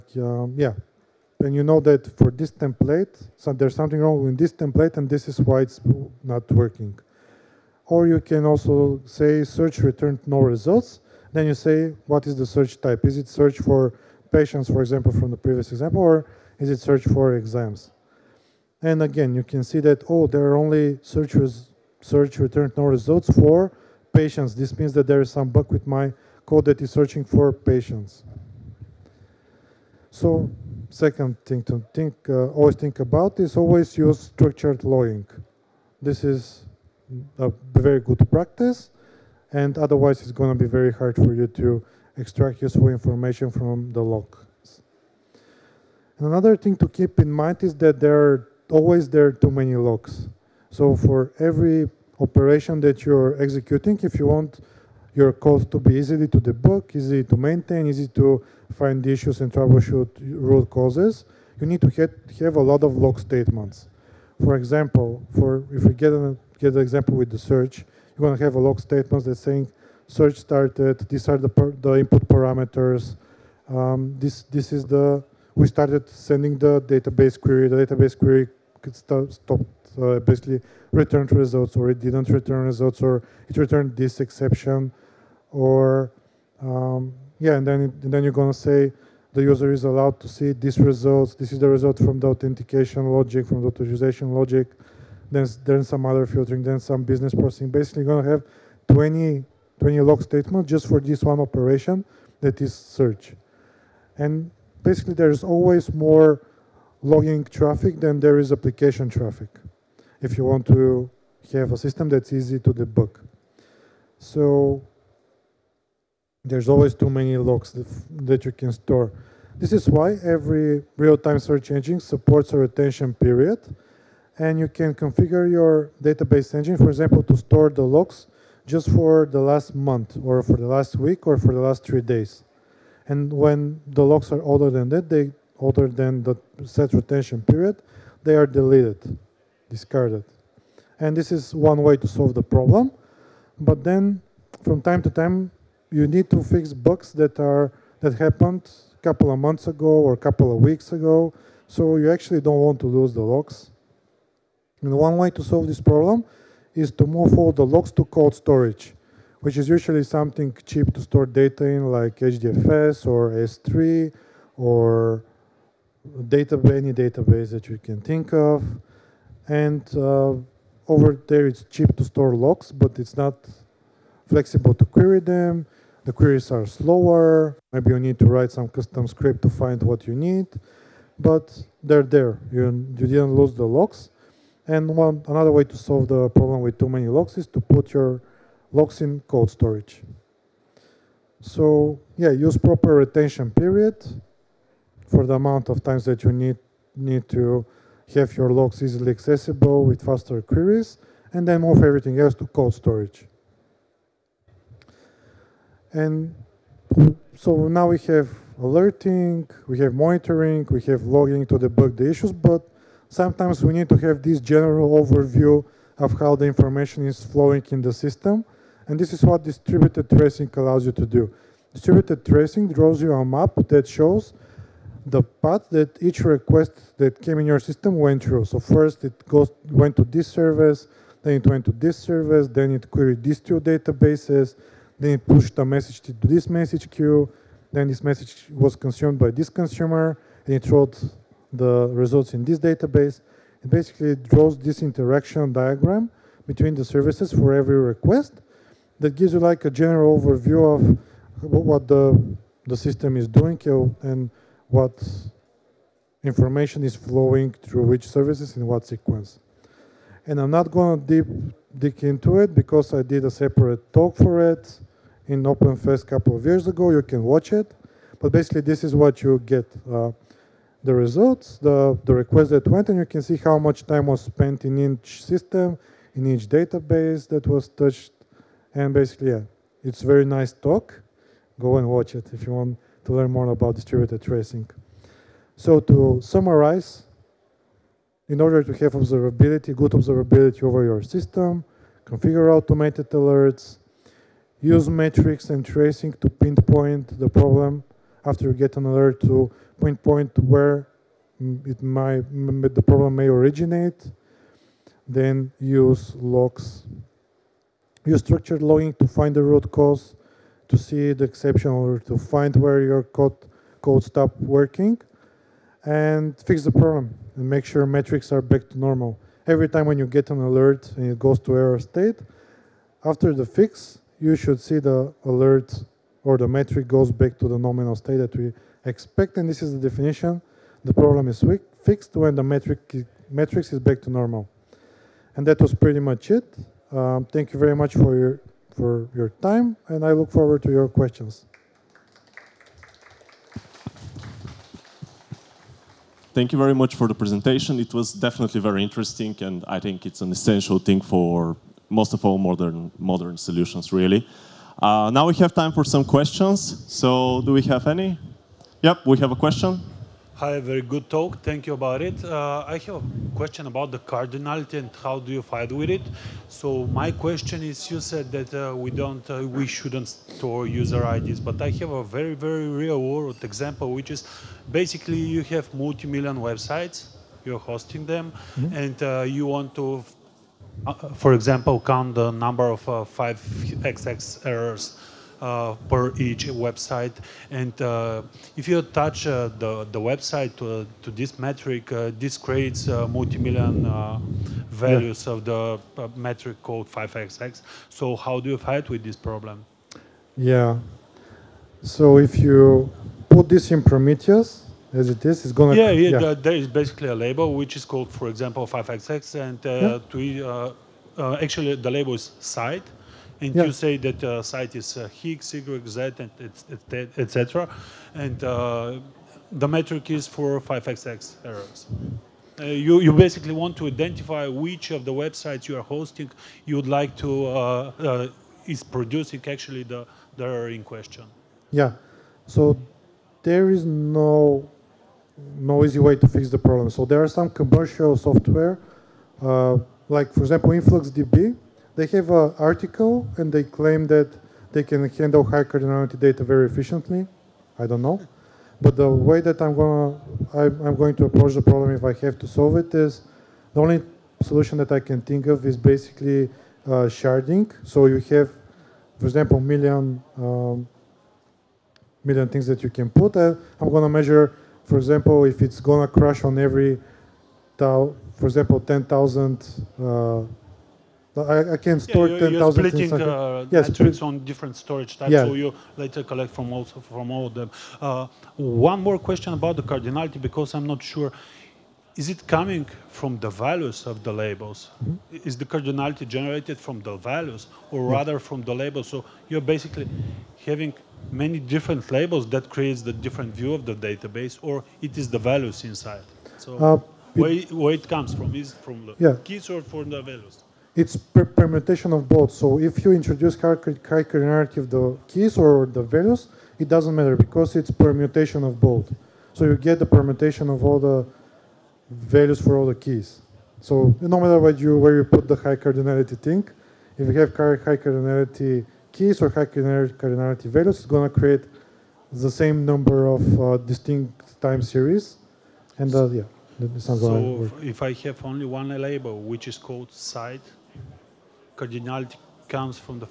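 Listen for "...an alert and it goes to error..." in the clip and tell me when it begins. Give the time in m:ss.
5:20.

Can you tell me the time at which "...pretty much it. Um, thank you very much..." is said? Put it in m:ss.
5:35.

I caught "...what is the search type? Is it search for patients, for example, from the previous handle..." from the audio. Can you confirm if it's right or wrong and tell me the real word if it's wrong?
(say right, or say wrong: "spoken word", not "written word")
wrong: "example", not "handle".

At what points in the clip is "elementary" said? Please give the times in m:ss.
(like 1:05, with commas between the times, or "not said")
not said.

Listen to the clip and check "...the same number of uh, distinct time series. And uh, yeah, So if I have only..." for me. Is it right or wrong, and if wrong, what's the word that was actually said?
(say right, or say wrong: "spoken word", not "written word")
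right.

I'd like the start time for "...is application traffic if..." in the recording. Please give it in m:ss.
1:48.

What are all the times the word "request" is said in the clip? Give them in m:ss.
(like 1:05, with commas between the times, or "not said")
3:46, 4:07, 4:32.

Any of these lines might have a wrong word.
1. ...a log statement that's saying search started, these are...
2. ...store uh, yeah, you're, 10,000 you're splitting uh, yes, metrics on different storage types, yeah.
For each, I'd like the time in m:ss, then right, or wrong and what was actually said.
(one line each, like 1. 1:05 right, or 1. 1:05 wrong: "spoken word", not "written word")
1. 1:08 right
2. 7:51 right.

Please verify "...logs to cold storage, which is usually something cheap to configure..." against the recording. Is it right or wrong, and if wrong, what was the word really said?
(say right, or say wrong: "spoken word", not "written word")
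wrong: "store", not "configure".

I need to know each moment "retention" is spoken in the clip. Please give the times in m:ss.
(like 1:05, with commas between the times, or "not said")
2:02, 2:16, 3:12.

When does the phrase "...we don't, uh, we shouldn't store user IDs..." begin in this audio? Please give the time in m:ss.
6:08.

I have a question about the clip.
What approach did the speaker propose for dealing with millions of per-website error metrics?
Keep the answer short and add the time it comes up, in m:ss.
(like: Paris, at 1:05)
Sharding, at 7:37.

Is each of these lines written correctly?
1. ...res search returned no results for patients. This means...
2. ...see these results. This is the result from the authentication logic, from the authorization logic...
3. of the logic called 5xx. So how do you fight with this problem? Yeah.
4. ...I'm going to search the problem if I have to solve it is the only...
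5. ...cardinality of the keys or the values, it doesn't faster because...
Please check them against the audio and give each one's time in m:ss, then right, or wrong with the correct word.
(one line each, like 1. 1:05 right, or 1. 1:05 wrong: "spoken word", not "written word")
1. 0:21 right
2. 1:30 right
3. 6:35 wrong: "metric", not "logic"
4. 7:30 wrong: "approach", not "search"
5. 8:23 wrong: "matter", not "faster".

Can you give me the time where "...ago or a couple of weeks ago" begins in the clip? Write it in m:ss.
2:29.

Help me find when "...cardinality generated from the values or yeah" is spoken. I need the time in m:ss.
8:05.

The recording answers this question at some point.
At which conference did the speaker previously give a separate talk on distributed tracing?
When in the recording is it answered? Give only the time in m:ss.
4:25.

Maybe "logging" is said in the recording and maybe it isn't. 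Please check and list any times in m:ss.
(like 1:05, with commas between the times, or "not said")
0:34, 1:47, 3:31, 5:08.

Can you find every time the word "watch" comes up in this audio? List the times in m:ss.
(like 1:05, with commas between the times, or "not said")
4:27, 4:41.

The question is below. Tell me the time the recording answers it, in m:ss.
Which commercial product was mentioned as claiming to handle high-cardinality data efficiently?
7:20.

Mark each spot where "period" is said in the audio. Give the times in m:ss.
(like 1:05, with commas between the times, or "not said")
2:03, 2:17, 3:13.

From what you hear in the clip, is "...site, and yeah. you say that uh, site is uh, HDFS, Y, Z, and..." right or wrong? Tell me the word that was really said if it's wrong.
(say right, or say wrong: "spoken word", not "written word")
wrong: "Higgs", not "HDFS".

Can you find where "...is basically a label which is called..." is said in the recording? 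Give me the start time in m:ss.
6:46.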